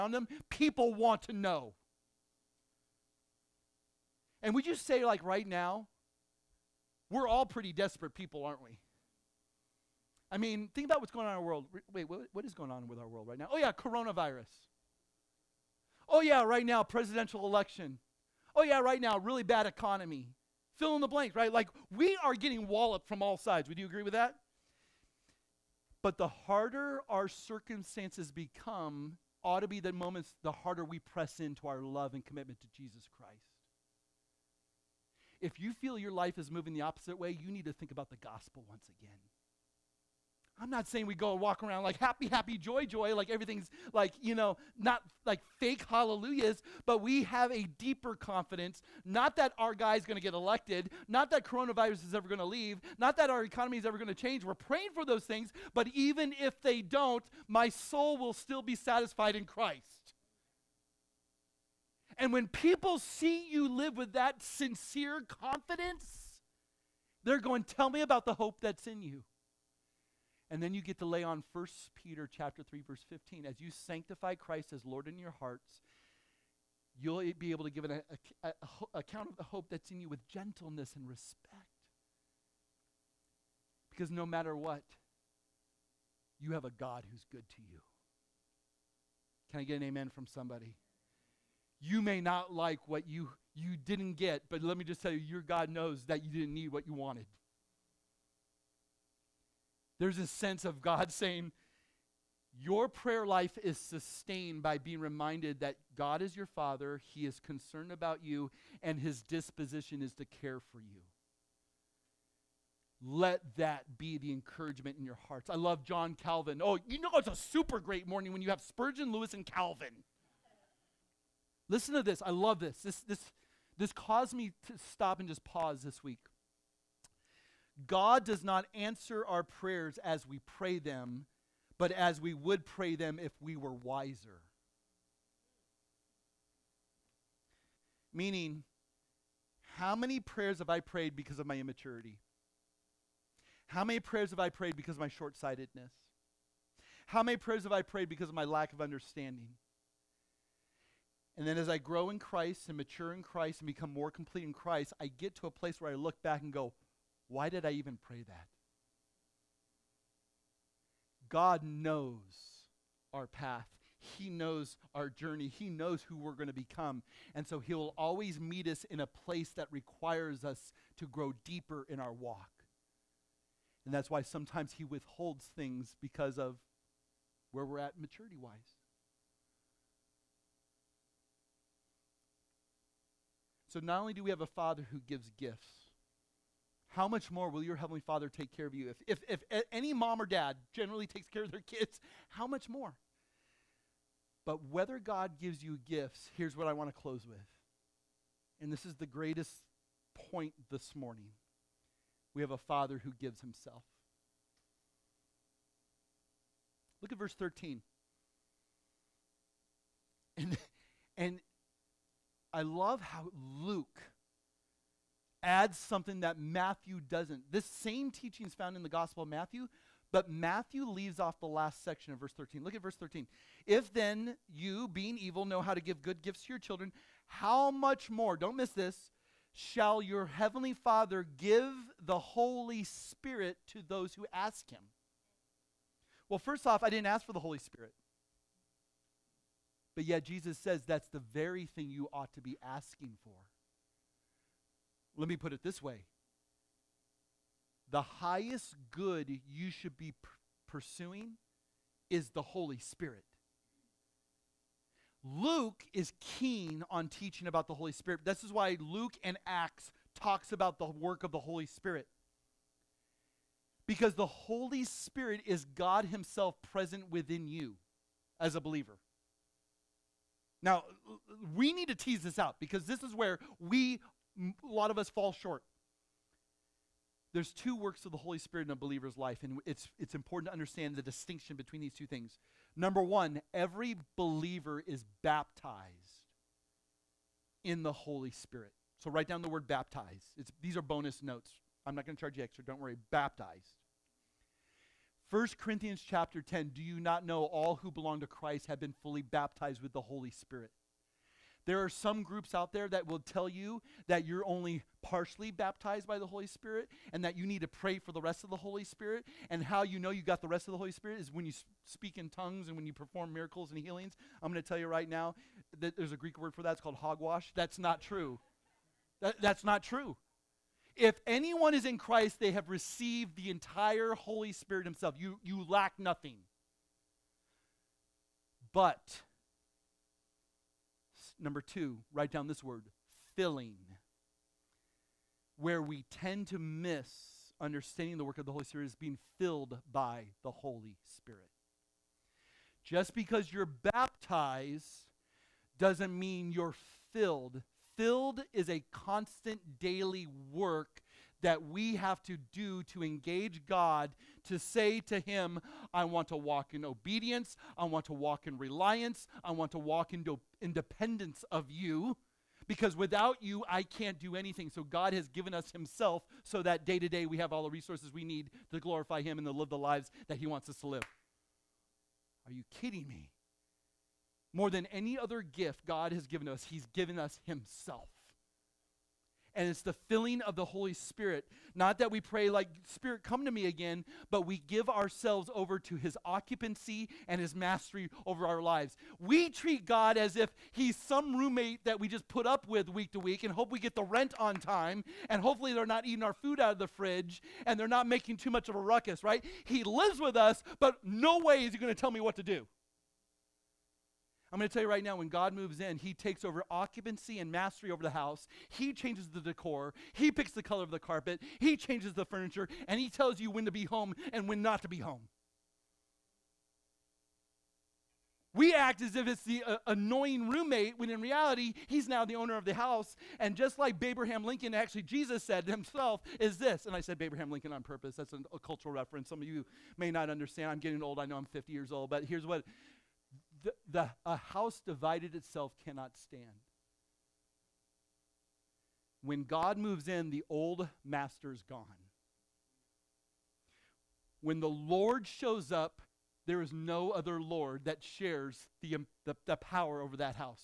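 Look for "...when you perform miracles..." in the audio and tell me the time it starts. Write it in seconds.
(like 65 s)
312 s.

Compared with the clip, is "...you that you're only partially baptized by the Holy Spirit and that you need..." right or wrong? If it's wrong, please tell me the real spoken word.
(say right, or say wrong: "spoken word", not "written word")
right.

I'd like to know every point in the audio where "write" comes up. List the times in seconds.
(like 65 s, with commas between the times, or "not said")
289 s, 332 s.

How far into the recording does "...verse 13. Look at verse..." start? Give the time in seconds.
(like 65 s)
222 s.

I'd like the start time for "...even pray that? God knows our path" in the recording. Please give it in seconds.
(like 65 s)
157 s.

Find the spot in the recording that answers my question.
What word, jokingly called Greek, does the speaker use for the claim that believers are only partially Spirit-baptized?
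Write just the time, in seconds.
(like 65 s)
316 s.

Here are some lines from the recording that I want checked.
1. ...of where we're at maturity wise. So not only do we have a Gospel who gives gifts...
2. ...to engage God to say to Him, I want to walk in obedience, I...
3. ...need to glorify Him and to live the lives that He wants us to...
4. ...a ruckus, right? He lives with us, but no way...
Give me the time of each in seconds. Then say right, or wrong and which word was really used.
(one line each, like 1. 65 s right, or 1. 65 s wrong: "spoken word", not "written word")
1. 176 s wrong: "Father", not "Gospel"
2. 352 s right
3. 368 s right
4. 398 s right.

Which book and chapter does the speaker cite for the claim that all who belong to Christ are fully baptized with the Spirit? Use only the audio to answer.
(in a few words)
1 Corinthians 10.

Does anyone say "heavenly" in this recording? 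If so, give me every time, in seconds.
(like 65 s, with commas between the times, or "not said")
187 s, 230 s.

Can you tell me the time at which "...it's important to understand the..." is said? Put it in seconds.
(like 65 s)
279 s.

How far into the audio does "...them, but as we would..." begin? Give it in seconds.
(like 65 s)
130 s.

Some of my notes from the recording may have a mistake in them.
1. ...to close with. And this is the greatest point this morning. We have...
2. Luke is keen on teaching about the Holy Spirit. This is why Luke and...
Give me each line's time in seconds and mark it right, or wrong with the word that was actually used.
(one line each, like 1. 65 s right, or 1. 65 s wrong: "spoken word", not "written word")
1. 196 s right
2. 255 s right.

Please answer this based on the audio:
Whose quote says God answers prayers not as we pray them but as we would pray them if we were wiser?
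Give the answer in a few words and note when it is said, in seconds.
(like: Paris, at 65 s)
John Calvin, at 115 s.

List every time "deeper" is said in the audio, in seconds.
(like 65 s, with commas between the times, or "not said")
47 s, 171 s.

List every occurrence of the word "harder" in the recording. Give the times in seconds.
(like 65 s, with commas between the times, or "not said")
26 s, 30 s.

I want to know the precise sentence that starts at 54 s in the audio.
We're praying for those things, but even if they don't, my soul will still be satisfied in Christ.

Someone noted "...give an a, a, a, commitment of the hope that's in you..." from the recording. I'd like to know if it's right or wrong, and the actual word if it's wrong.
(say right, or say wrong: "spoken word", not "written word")
wrong: "account", not "commitment".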